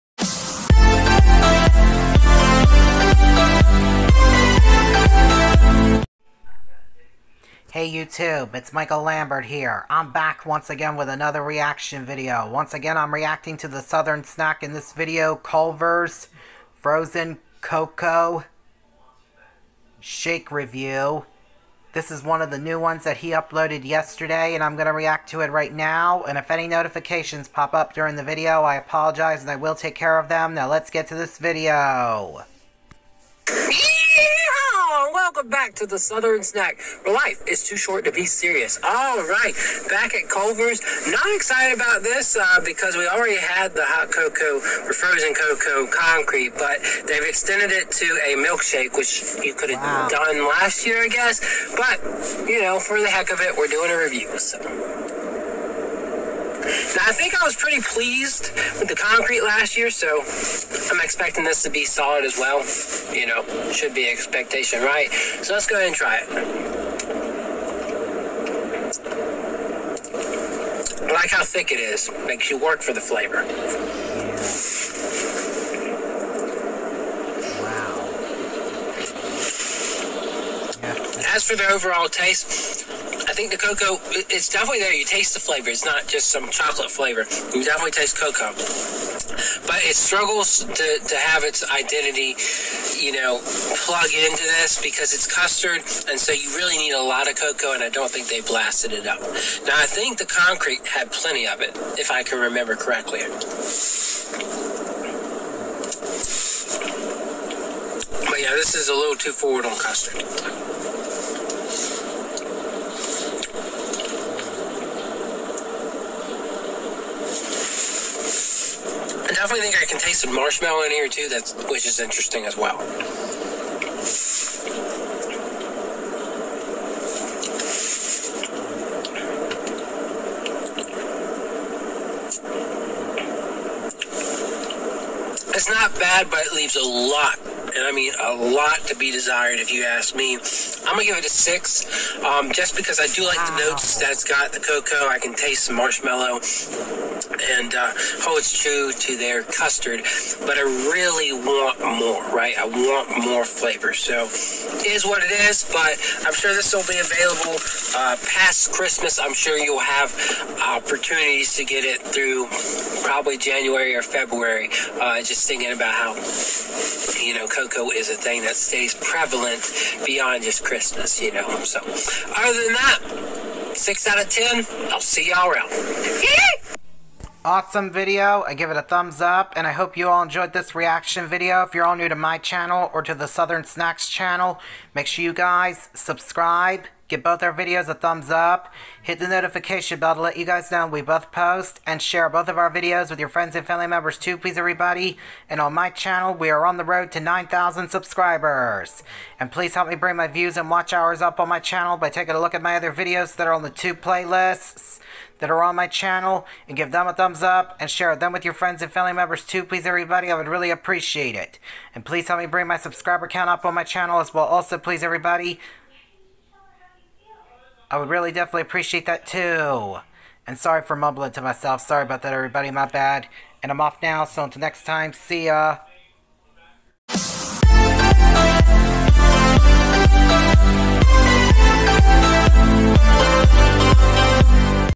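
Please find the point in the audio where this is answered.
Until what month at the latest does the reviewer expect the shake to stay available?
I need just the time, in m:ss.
2:44.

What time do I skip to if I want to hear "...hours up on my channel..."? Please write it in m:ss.
3:20.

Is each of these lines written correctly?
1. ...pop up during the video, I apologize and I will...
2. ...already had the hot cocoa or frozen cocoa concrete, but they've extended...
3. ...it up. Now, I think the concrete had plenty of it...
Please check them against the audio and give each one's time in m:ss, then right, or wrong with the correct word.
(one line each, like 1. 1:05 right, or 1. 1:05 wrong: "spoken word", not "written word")
1. 0:27 right
2. 0:43 right
3. 1:38 right.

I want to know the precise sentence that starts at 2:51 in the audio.
So, other than that, six out of ten.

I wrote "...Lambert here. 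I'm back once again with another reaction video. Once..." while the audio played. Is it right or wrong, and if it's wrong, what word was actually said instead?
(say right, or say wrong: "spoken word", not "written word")
right.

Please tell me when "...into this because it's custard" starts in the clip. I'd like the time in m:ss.
1:34.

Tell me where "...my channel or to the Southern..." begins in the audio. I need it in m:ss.
3:02.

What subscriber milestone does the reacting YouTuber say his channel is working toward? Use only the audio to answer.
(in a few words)
9,000.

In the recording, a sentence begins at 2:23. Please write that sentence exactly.
the notes that's got the cocoa.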